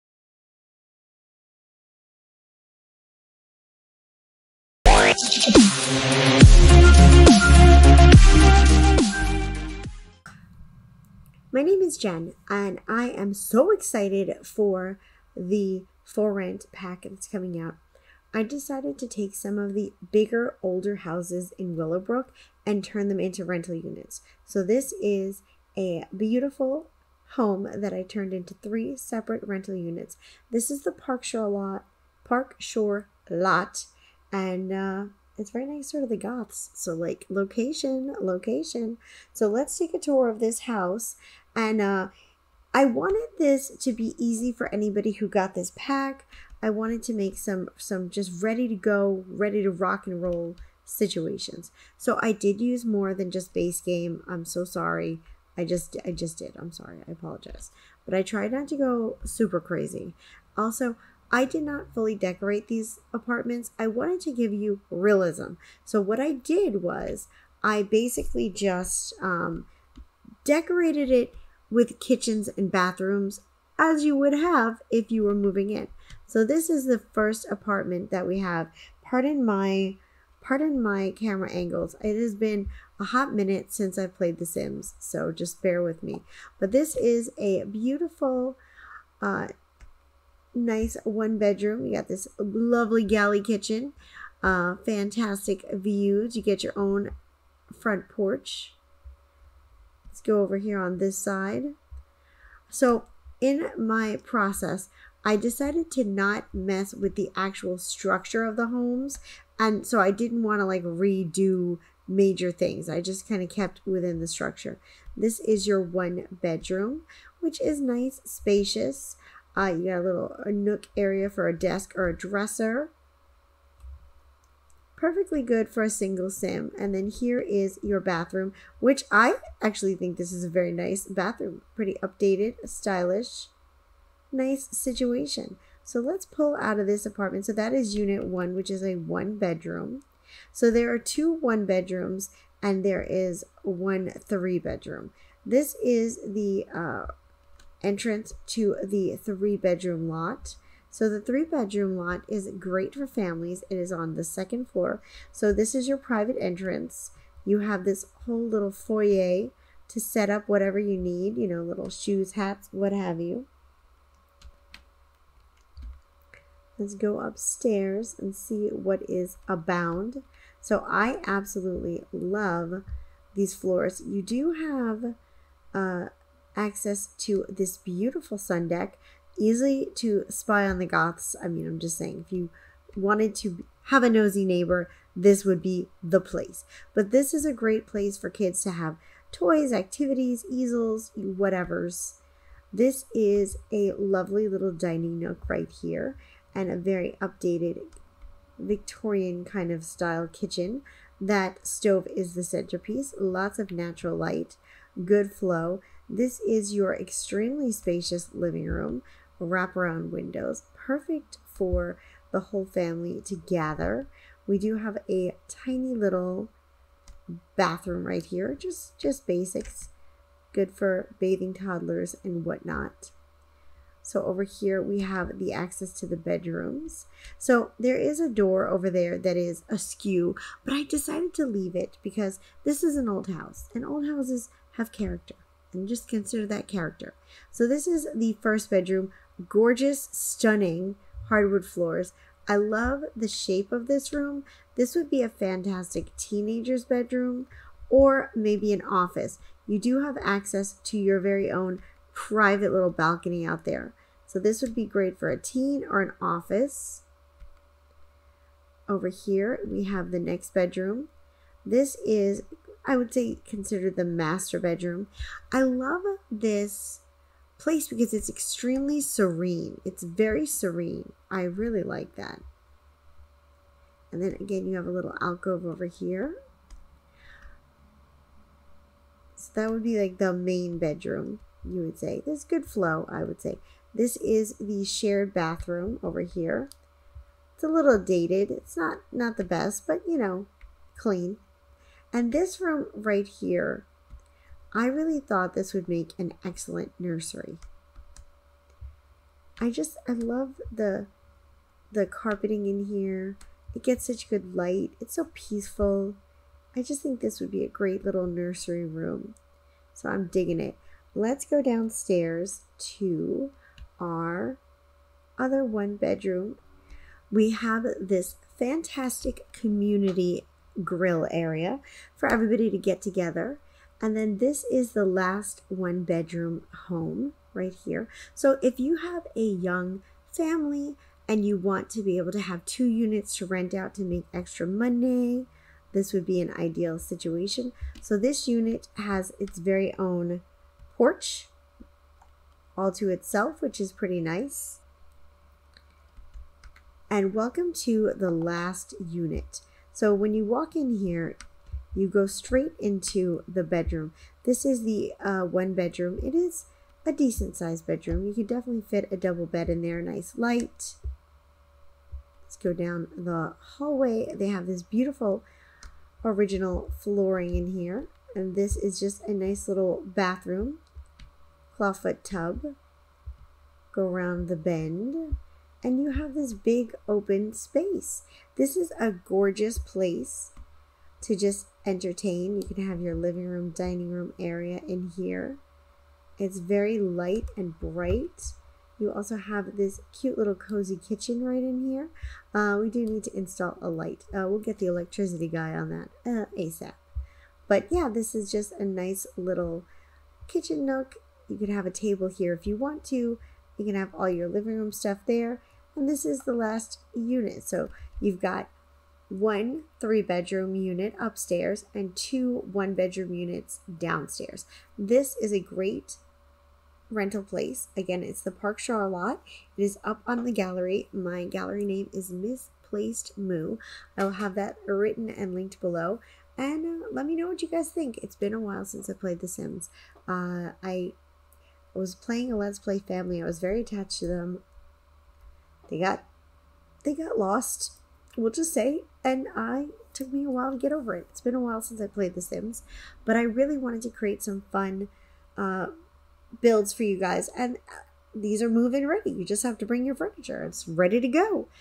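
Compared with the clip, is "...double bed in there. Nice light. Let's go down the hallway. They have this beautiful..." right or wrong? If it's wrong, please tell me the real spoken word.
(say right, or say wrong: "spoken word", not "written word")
right.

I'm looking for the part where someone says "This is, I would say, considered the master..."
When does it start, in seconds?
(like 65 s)
261 s.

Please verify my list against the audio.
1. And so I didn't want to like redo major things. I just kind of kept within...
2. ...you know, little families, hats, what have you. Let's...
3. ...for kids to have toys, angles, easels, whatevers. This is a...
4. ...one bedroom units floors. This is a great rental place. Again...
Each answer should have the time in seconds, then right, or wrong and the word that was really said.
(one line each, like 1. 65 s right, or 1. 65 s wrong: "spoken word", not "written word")
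1. 109 s right
2. 161 s wrong: "shoes", not "families"
3. 188 s wrong: "activities", not "angles"
4. 412 s wrong: "downstairs", not "floors".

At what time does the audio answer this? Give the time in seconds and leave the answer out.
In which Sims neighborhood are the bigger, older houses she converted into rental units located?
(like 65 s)
21 s.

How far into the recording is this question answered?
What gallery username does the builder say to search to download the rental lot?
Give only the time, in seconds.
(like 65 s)
422 s.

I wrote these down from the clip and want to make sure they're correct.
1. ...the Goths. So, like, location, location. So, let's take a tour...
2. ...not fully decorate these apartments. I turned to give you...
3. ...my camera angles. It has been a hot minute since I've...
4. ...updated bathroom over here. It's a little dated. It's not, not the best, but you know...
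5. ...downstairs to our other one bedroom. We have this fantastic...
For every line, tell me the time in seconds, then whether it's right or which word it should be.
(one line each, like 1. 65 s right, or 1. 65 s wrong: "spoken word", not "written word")
1. 36 s right
2. 61 s wrong: "wanted", not "turned"
3. 80 s right
4. 284 s wrong: "shared", not "updated"
5. 311 s right.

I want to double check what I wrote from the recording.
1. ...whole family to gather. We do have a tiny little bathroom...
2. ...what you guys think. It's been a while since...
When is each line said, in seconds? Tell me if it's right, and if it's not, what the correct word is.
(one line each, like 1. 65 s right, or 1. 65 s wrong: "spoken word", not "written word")
1. 212 s right
2. 427 s right.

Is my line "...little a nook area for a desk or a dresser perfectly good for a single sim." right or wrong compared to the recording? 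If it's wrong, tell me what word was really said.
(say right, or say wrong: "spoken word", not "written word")
right.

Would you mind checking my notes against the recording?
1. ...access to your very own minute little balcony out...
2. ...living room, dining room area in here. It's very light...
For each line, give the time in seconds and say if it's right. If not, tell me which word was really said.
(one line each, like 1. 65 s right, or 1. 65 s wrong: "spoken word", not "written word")
1. 250 s wrong: "private", not "minute"
2. 383 s right.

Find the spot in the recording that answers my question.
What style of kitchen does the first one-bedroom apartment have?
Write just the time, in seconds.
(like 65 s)
93 s.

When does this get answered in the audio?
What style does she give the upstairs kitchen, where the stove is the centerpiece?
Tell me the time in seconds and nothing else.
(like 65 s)
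198 s.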